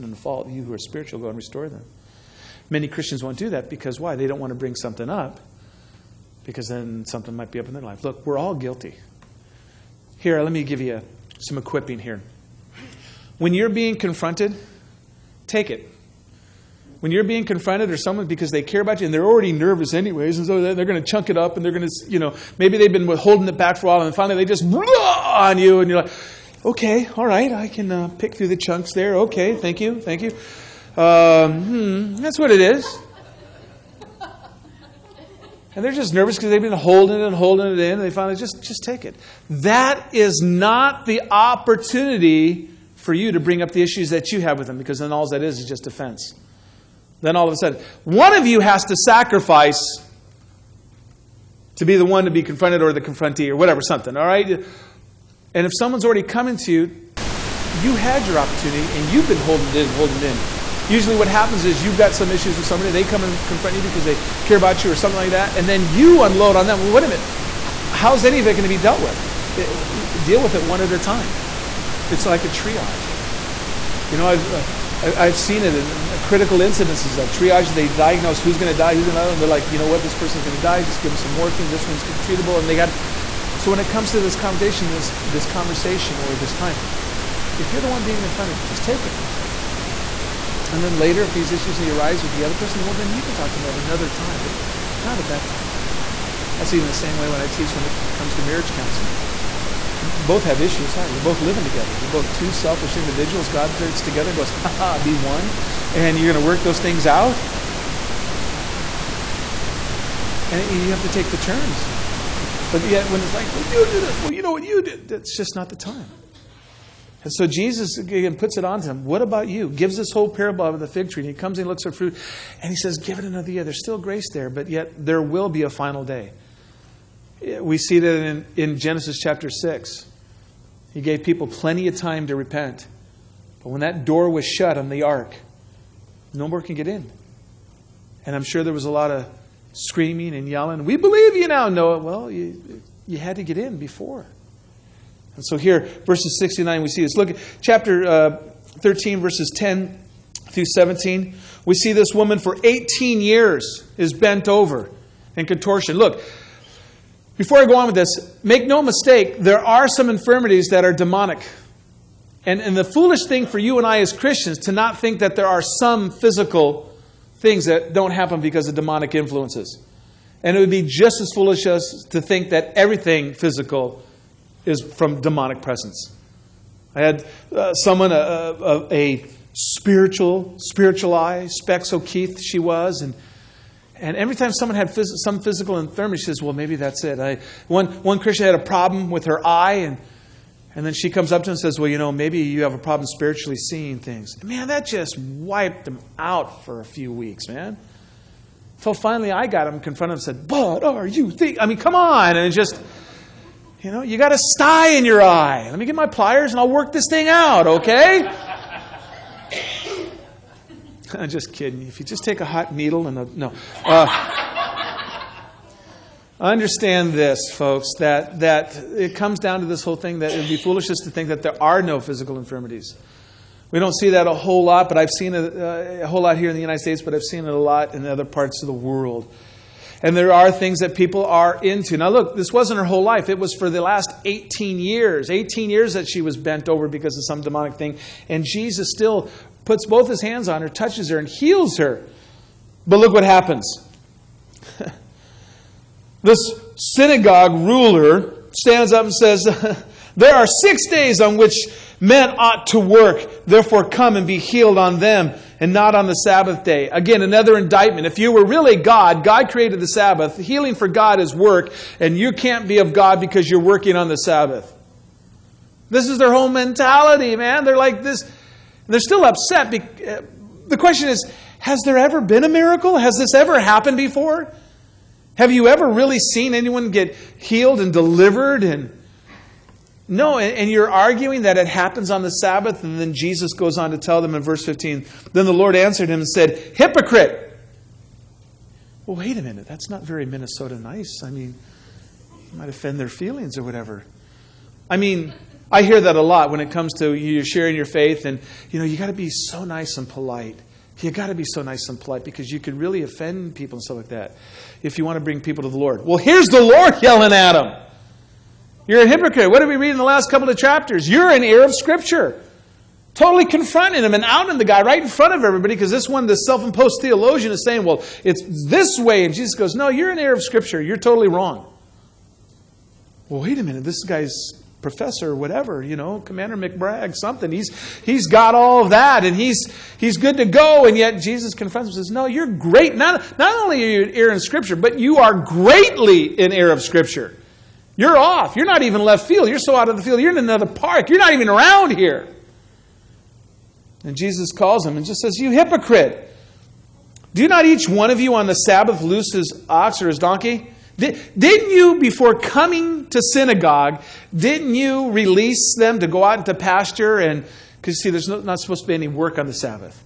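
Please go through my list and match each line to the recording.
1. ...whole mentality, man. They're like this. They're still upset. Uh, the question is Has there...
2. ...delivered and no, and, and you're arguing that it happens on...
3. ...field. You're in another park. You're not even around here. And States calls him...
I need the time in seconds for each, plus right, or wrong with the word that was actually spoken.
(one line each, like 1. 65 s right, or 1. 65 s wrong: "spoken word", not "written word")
1. 266 s right
2. 277 s right
3. 340 s wrong: "Jesus", not "States".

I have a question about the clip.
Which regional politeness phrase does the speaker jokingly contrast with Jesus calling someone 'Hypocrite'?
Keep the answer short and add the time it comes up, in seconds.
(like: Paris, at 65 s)
Minnesota nice, at 290 s.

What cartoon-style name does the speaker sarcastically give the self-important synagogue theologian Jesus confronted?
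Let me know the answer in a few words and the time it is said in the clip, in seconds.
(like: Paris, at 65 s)
Commander McBragg, at 326 s.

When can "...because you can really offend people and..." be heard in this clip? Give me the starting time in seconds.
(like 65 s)
302 s.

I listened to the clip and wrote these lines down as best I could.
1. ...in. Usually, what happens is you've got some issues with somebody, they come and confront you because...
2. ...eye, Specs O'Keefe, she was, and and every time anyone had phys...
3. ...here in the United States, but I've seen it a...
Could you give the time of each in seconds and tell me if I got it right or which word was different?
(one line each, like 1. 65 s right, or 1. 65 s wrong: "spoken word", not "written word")
1. 60 s right
2. 181 s wrong: "someone", not "anyone"
3. 226 s right.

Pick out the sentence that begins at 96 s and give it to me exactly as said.
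That's even the same way when I teach when it comes to marriage counseling.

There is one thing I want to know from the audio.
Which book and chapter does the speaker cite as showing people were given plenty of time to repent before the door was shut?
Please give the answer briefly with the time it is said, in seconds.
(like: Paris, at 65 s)
Genesis chapter 6, at 128 s.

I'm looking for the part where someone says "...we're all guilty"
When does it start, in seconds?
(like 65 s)
8 s.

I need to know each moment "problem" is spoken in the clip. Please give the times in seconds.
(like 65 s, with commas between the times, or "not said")
188 s, 192 s.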